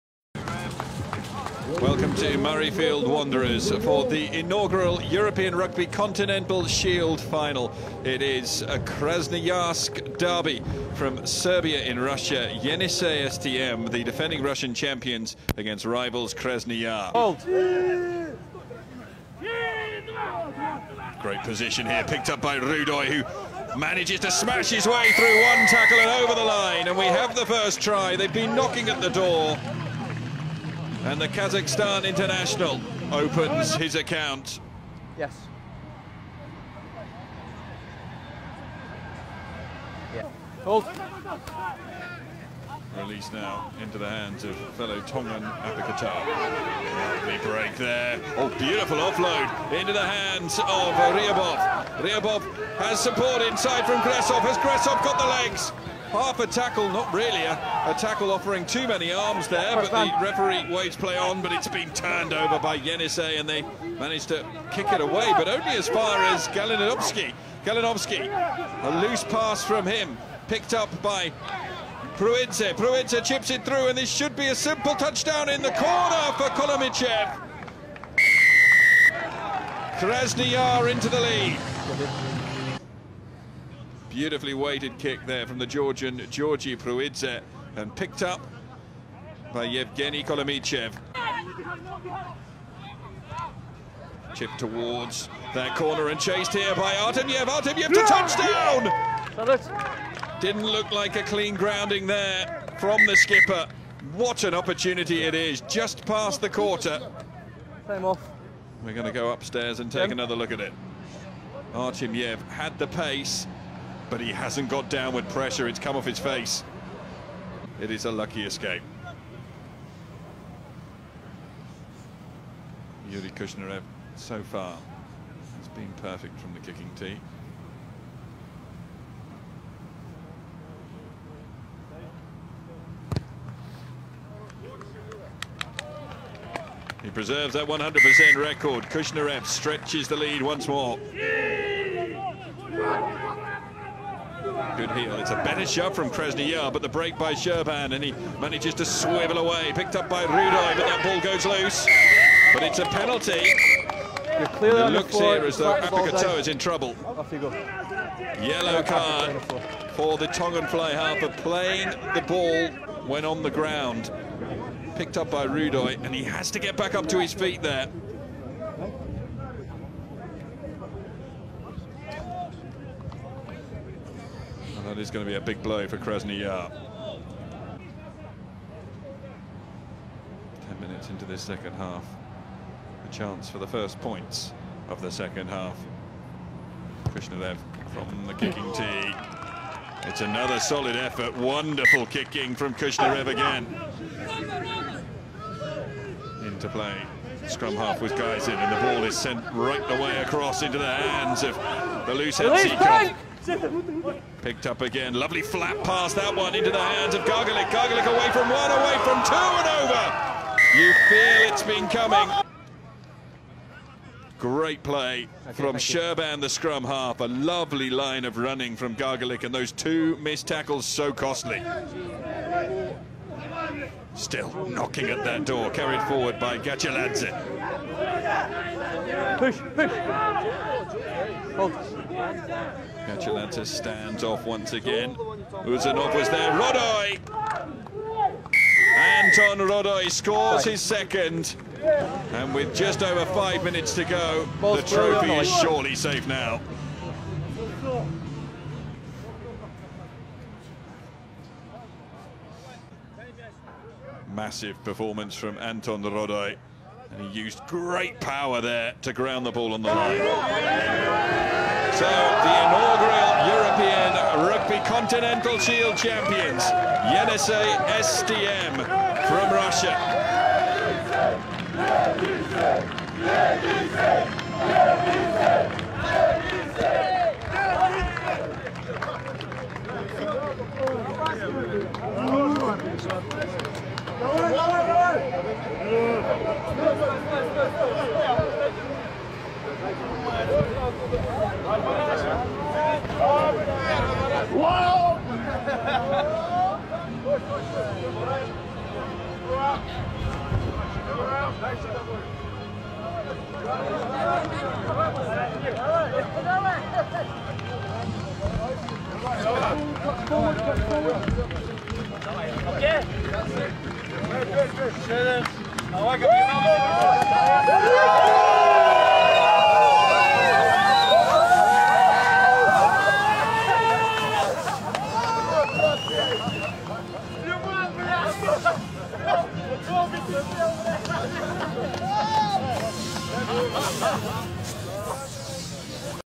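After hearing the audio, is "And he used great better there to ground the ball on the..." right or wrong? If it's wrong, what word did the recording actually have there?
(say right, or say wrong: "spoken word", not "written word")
wrong: "power", not "better".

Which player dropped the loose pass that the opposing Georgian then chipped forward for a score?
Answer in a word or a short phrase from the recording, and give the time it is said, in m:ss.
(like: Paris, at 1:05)
Galinovsky, at 1:07.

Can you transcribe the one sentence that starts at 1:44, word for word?
What an opportunity it is, just past the quarter.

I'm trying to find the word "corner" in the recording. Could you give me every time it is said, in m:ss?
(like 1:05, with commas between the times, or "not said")
1:15, 1:35.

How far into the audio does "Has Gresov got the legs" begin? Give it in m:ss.
0:54.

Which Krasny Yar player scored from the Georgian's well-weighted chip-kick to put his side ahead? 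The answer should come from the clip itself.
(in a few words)
Yevgeny Kolomichev.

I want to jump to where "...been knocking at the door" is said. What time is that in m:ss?
0:28.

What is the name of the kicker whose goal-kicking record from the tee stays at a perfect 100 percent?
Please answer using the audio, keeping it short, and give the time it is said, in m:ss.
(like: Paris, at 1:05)
Yuri Kushnarev, at 2:03.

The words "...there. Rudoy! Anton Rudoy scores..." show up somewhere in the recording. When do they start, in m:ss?
3:56.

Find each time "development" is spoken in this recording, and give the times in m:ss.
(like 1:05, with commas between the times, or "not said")
not said.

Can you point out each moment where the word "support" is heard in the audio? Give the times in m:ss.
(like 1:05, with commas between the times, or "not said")
0:52.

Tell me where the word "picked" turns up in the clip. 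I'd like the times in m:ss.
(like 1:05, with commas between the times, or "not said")
0:22, 1:10, 1:27, 2:29, 2:44, 3:24.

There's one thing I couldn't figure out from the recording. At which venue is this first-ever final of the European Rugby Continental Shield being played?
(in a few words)
Murrayfield Wanderers.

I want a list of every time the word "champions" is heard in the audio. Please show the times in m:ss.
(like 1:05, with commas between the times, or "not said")
0:14, 4:25.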